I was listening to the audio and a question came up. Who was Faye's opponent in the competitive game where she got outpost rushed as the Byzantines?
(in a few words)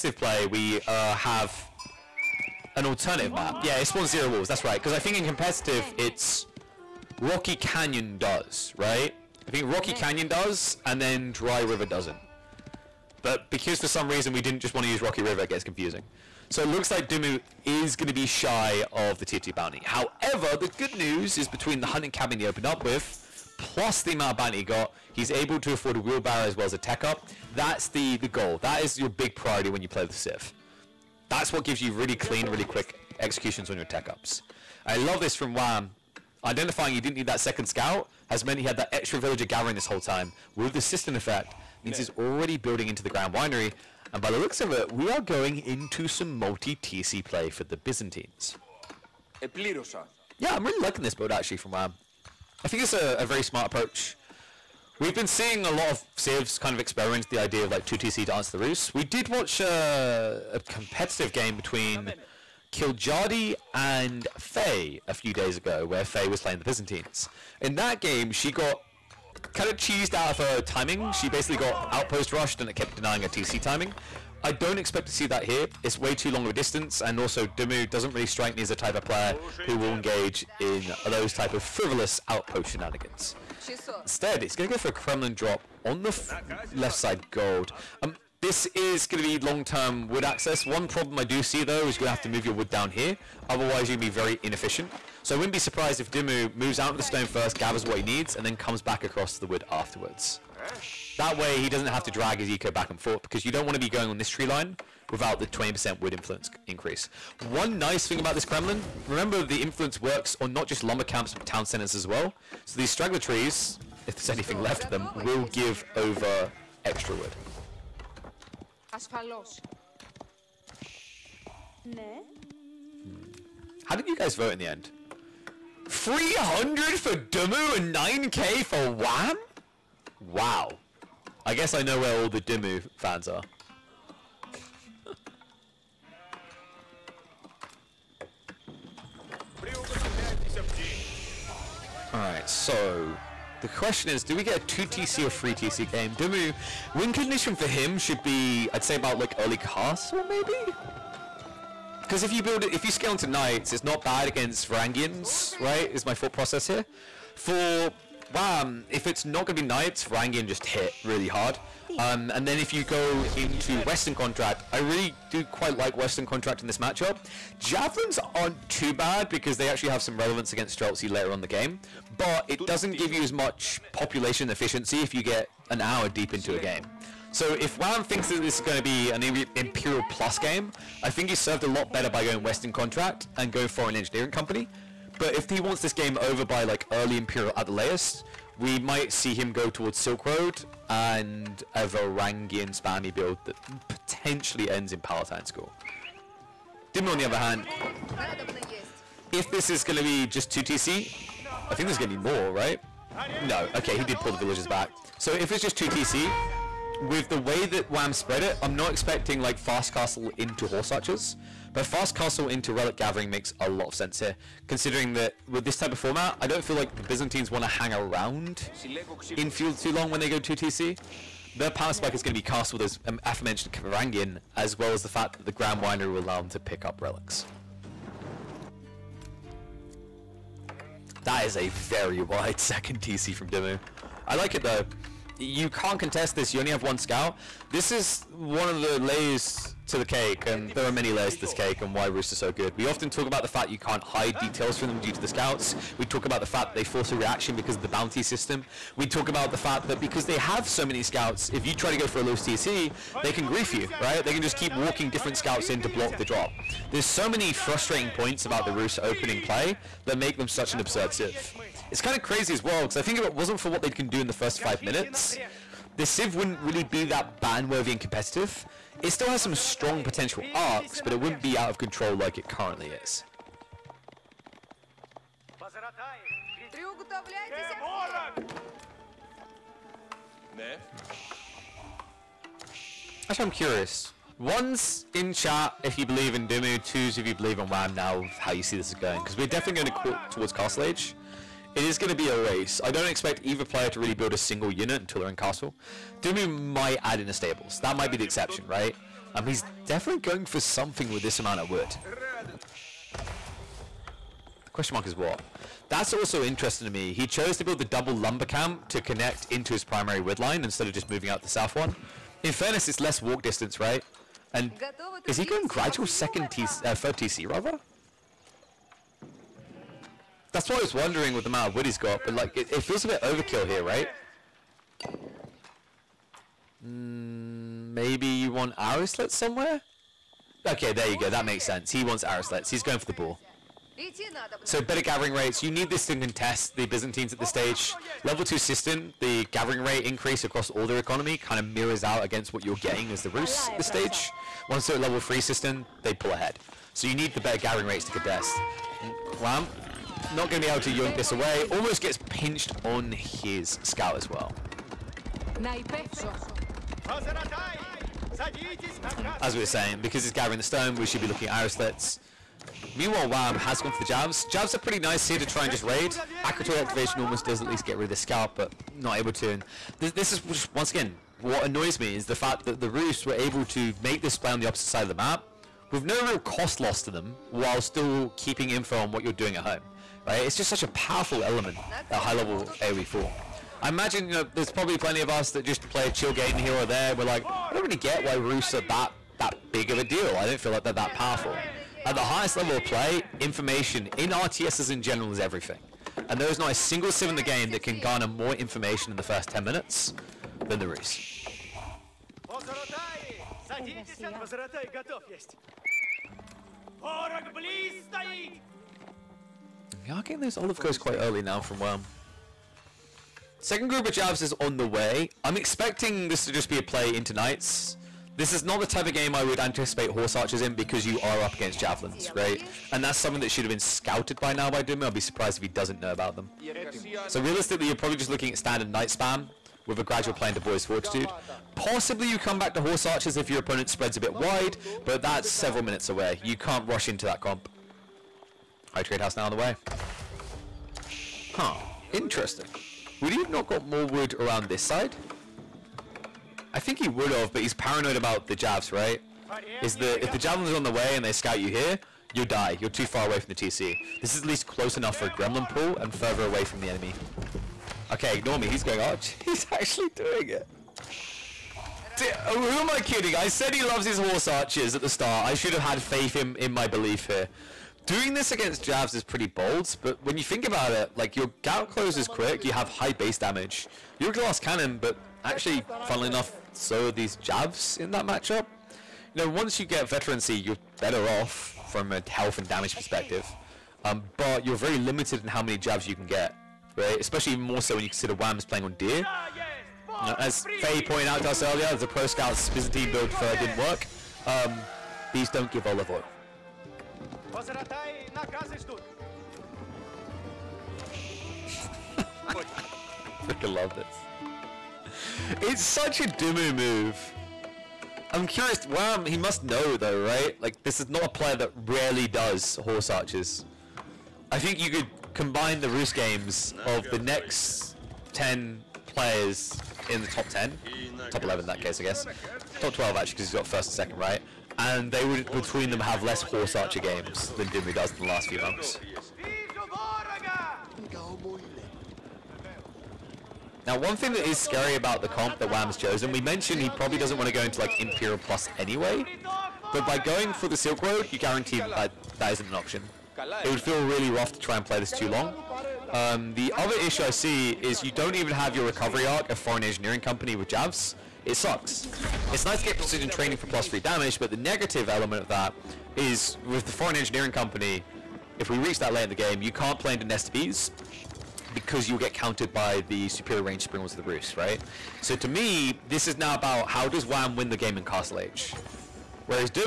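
Killed Jardi.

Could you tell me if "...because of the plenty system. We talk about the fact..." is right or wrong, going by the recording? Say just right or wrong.
wrong.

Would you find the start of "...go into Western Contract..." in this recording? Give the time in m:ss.
2:42.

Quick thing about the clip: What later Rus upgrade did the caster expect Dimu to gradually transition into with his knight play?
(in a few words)
Boyar's Fortitude.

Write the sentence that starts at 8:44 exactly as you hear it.
And they would, between them, have less Horse Archer games than Dimu does in the last few months.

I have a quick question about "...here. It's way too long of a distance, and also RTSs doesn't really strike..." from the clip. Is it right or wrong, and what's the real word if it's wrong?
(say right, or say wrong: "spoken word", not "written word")
wrong: "Dimu", not "RTSs".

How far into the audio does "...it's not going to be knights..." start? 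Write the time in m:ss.
2:39.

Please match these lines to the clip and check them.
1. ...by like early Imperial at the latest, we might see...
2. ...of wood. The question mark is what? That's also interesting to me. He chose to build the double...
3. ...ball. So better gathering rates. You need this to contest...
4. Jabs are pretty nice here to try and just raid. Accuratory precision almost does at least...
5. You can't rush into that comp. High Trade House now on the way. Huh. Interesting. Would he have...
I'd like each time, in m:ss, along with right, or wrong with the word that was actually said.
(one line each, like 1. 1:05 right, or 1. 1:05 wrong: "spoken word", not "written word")
1. 3:06 right
2. 5:01 right
3. 5:33 right
4. 6:04 wrong: "activation", not "precision"
5. 7:16 right.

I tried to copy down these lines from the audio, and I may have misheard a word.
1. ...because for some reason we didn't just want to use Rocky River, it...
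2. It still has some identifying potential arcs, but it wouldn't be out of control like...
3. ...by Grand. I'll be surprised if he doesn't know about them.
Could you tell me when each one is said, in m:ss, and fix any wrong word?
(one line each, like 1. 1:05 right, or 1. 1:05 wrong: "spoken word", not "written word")
1. 0:13 right
2. 4:29 wrong: "strong", not "identifying"
3. 7:04 wrong: "Dimu", not "Grand".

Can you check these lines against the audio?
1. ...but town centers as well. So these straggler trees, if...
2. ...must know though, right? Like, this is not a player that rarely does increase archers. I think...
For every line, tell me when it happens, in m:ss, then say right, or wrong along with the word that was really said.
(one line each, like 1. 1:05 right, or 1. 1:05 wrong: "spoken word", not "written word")
1. 1:51 right
2. 8:29 wrong: "horse", not "increase".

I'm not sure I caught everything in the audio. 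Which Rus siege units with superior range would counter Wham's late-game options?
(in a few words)
springalds.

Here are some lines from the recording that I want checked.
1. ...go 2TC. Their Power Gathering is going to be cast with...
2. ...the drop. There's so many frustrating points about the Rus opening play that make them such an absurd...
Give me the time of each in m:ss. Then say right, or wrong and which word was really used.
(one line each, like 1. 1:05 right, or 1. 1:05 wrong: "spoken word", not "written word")
1. 3:40 wrong: "Spike", not "Gathering"
2. 4:16 right.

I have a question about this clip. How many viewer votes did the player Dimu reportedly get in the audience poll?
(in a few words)
300.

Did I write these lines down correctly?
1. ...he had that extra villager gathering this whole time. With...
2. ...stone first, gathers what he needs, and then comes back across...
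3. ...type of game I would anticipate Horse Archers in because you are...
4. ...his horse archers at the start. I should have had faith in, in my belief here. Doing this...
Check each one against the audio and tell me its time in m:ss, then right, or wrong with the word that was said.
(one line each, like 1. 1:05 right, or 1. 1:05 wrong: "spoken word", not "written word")
1. 0:38 right
2. 1:37 right
3. 6:58 right
4. 7:44 right.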